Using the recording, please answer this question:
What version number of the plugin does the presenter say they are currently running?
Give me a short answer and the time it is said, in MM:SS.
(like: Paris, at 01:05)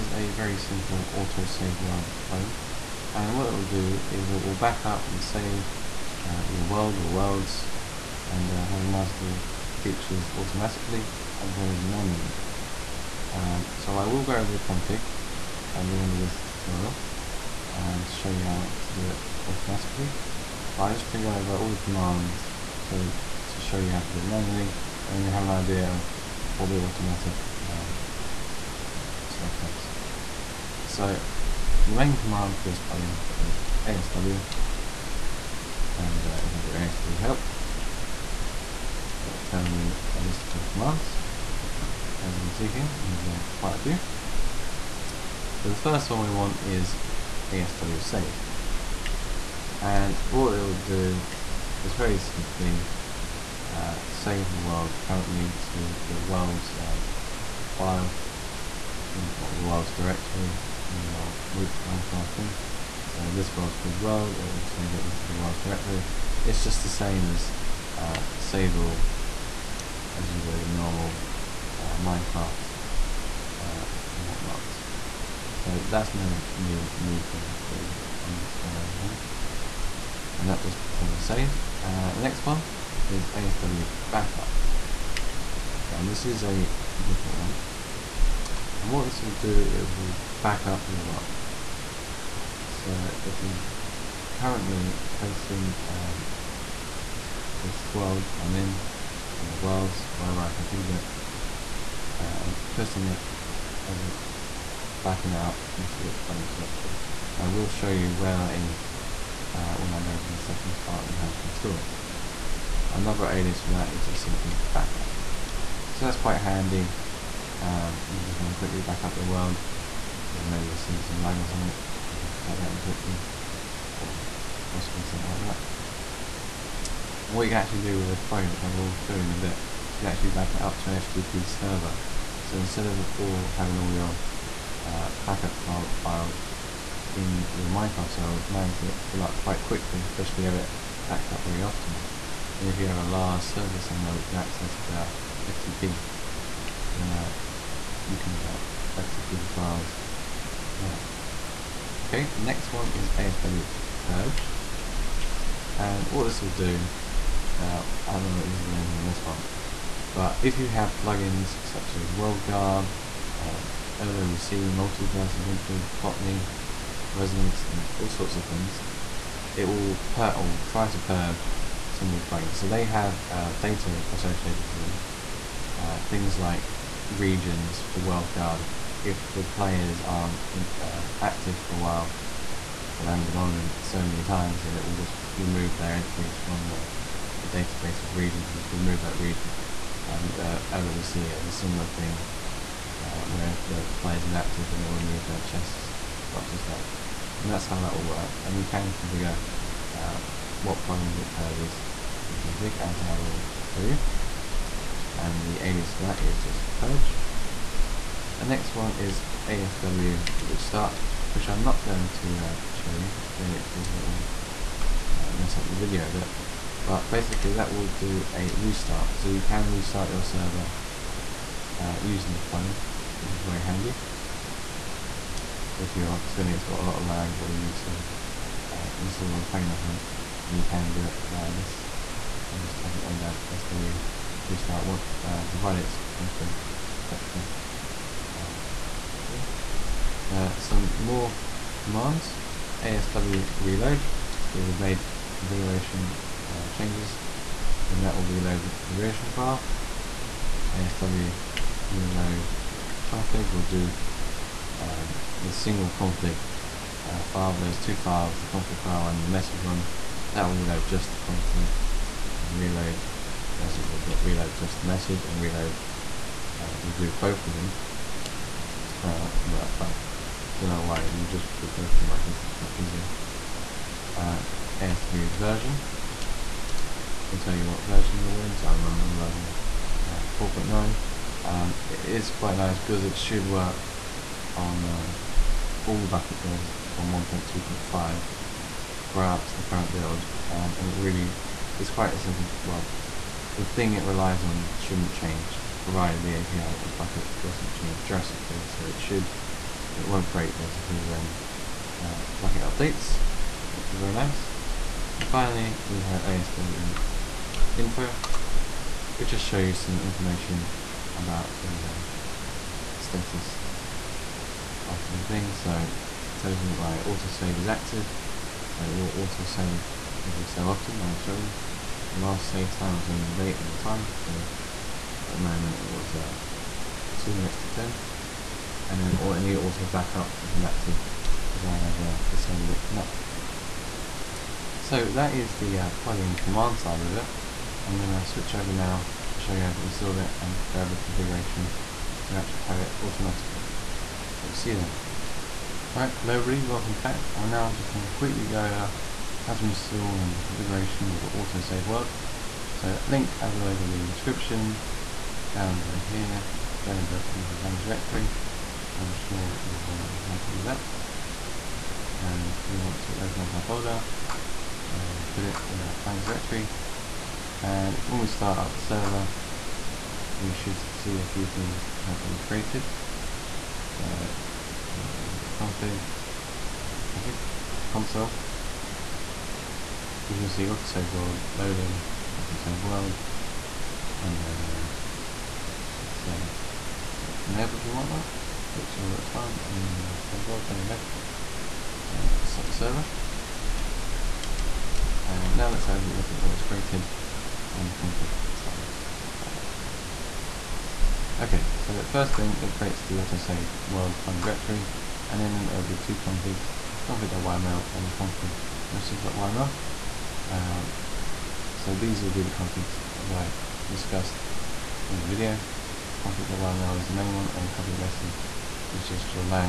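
4.9, at 04:40.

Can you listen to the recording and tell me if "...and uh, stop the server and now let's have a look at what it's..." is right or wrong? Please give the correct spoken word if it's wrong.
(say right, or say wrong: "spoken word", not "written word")
right.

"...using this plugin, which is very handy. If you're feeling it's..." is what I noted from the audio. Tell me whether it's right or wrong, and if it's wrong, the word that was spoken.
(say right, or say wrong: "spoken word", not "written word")
right.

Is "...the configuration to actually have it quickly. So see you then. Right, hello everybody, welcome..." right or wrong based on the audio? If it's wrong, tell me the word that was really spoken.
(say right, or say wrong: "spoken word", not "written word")
wrong: "automatically", not "quickly".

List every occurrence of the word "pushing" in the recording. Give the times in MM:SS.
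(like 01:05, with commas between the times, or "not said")
01:42.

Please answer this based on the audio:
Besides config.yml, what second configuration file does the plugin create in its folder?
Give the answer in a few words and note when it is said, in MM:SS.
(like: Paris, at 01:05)
config message.yml, at 06:48.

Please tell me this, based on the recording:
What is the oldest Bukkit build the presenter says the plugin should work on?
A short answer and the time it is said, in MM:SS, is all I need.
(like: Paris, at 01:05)
1.2.5, at 04:47.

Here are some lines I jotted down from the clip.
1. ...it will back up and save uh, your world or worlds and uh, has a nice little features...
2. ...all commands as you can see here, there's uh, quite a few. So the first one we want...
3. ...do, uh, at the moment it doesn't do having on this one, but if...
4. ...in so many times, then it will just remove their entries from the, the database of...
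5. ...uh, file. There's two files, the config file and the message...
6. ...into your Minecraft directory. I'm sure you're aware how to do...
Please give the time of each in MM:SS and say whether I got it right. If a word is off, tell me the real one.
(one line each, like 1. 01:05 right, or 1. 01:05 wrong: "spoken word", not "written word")
1. 00:04 right
2. 00:40 right
3. 02:36 wrong: "anything", not "having"
4. 03:03 right
5. 04:17 right
6. 05:57 wrong: "Blender", not "Minecraft".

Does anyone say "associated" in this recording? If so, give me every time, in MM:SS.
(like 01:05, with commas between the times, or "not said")
02:54.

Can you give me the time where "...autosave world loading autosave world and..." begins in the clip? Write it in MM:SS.
06:20.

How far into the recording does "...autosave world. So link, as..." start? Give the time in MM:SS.
05:51.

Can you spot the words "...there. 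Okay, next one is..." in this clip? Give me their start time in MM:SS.
02:30.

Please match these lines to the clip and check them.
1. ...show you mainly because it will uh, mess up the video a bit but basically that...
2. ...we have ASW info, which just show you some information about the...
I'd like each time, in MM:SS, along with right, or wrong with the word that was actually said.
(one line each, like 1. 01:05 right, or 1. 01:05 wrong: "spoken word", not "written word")
1. 03:32 right
2. 05:05 right.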